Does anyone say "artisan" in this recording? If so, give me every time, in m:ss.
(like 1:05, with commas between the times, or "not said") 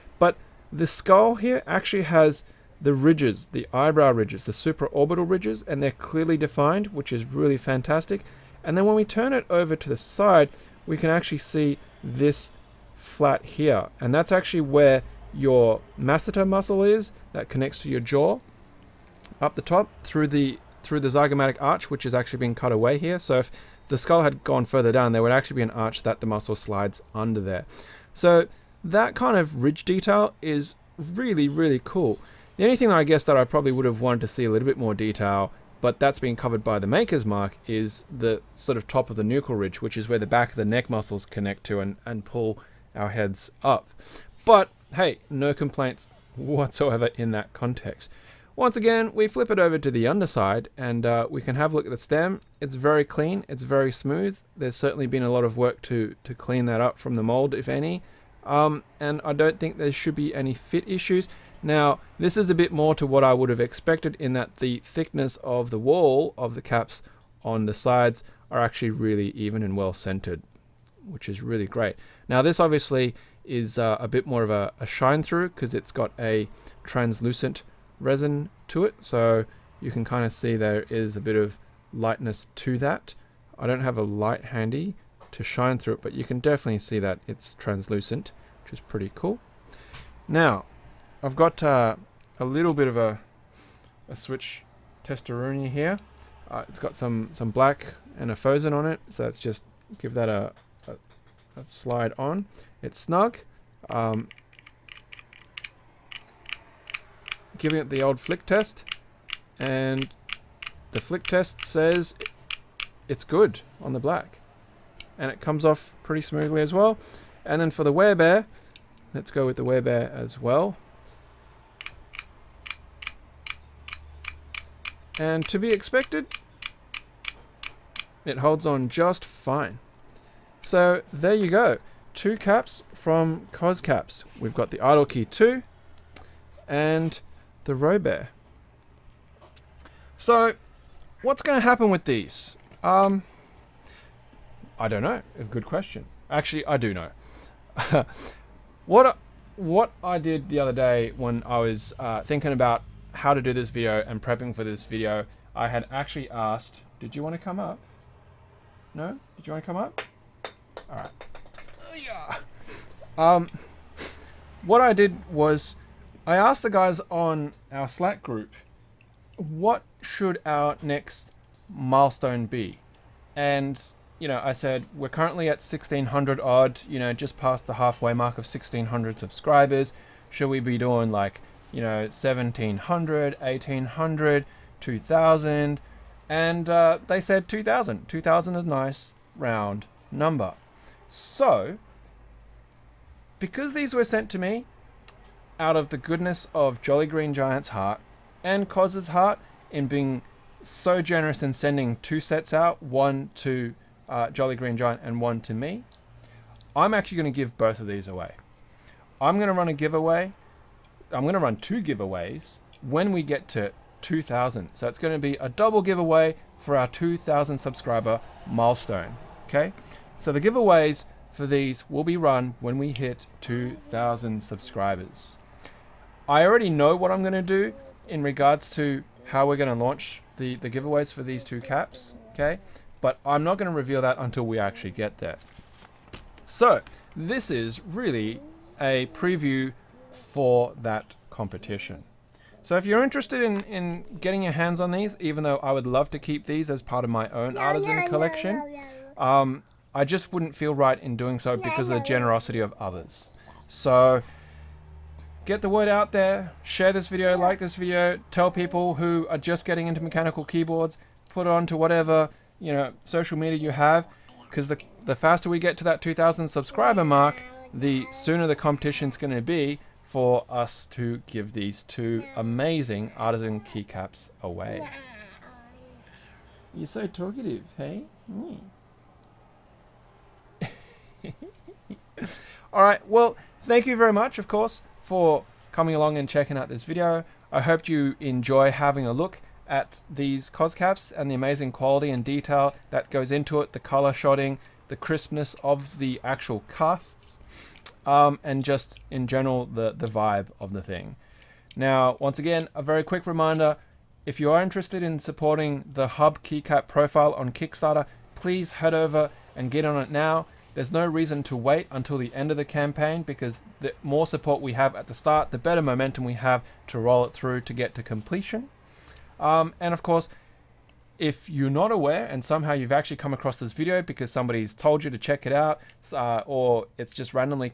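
4:07, 4:33.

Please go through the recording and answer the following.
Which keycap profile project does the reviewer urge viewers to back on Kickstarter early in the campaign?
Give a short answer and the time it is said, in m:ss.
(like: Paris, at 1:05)
Hub, at 5:06.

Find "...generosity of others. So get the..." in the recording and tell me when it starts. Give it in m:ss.
4:12.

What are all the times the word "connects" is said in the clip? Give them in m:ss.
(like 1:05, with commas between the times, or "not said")
0:17, 0:41.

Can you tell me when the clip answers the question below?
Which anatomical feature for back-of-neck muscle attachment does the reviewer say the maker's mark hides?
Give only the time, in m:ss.
0:39.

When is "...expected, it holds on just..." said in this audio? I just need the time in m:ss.
2:05.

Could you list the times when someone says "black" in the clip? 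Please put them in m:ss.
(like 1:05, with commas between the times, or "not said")
1:37, 1:53.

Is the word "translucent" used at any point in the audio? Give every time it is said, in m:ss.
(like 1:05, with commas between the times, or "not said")
1:16, 1:27.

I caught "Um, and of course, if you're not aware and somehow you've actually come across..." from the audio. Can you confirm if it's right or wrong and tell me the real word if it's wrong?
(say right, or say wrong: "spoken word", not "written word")
right.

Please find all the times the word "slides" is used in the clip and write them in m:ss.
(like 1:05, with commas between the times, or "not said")
0:26, 1:41.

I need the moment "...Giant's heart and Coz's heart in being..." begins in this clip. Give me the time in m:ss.
3:17.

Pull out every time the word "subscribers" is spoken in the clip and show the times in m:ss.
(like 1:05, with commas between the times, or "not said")
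2:59, 3:37, 3:44, 4:26.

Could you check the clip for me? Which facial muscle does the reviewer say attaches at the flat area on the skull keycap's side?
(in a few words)
masseter.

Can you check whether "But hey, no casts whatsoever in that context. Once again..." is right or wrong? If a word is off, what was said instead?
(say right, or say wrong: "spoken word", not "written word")
wrong: "complaints", not "casts".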